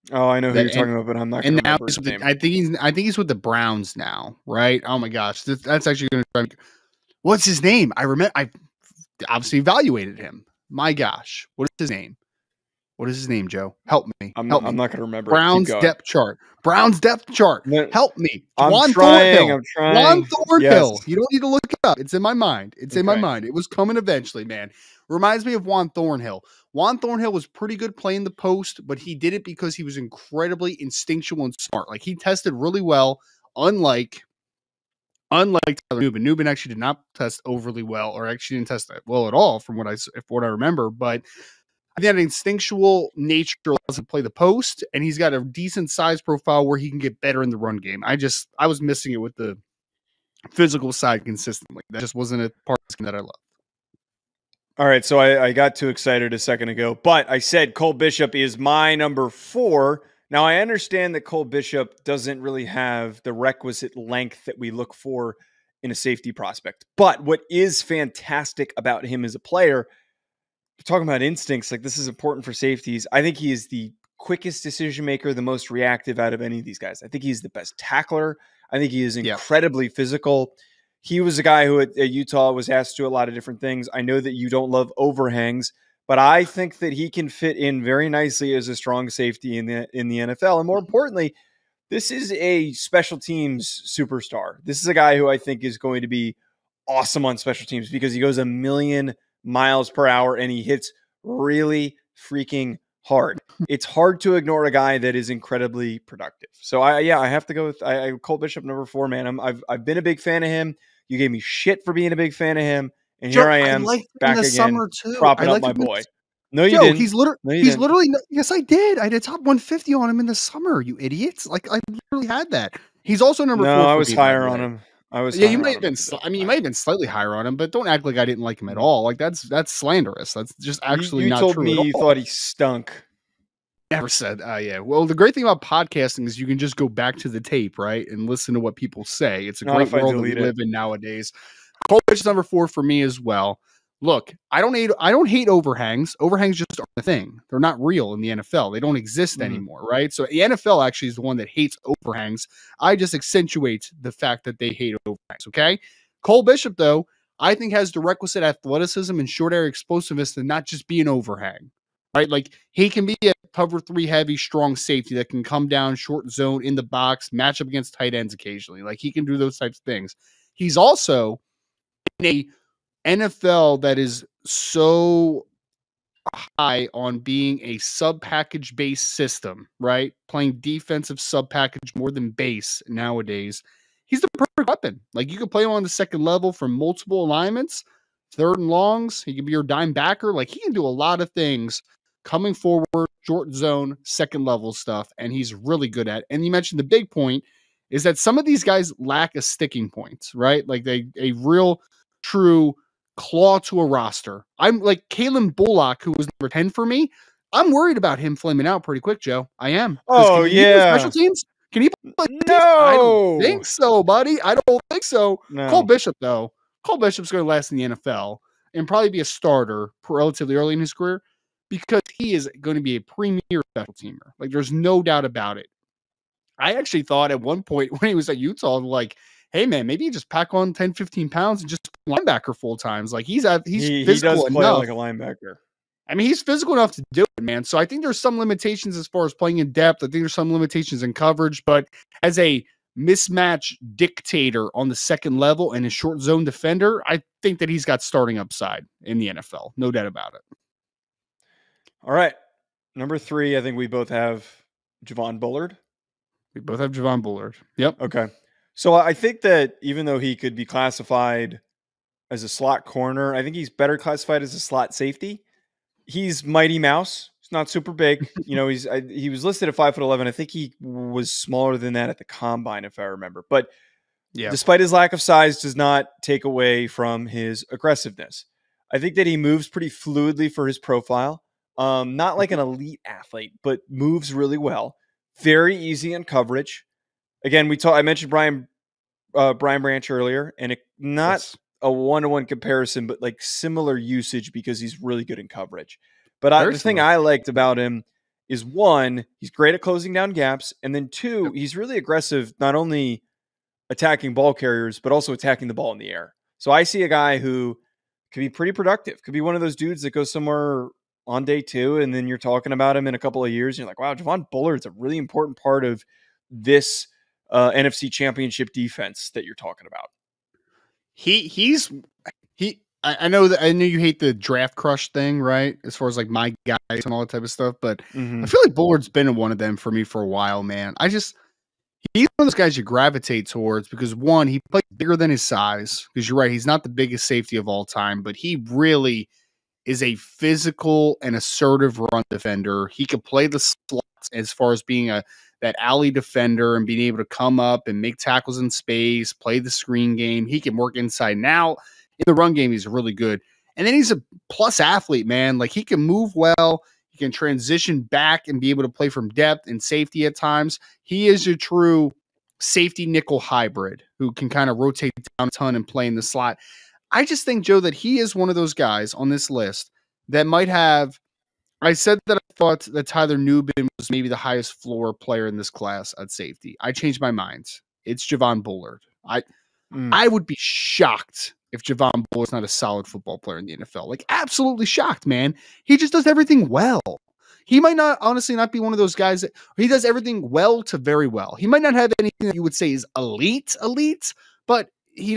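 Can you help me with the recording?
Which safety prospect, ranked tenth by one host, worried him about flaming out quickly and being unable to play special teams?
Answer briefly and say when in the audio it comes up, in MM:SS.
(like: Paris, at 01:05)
Calen Bullock, at 03:25.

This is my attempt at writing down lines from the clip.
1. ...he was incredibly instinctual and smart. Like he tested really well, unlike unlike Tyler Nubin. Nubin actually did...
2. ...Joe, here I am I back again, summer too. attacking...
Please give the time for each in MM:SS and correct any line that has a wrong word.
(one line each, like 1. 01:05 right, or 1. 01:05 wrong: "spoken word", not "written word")
1. 00:29 right
2. 01:53 wrong: "propping", not "attacking".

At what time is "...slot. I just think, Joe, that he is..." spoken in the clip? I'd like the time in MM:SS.
06:06.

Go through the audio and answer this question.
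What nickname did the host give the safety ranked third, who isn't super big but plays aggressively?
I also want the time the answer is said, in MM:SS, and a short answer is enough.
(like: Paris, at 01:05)
Mighty Mouse, at 04:26.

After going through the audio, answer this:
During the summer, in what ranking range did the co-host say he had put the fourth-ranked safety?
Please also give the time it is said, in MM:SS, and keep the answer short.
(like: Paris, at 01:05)
top 150, at 01:59.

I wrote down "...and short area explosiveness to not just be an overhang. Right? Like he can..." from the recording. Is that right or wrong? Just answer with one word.
right.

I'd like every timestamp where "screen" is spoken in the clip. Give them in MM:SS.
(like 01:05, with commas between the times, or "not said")
05:49.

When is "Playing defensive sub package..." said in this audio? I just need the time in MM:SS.
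03:00.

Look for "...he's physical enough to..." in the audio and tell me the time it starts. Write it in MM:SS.
03:56.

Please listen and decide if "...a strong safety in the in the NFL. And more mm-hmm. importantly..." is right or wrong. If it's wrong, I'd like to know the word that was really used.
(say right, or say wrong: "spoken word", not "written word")
right.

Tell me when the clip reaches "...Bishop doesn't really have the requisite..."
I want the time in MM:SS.
01:01.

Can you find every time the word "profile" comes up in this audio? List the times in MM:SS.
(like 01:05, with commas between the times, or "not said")
00:46, 04:40.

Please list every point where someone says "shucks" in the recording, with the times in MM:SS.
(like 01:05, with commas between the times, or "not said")
not said.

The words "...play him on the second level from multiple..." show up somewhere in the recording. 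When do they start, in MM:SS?
03:05.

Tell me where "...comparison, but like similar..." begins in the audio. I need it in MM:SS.
04:52.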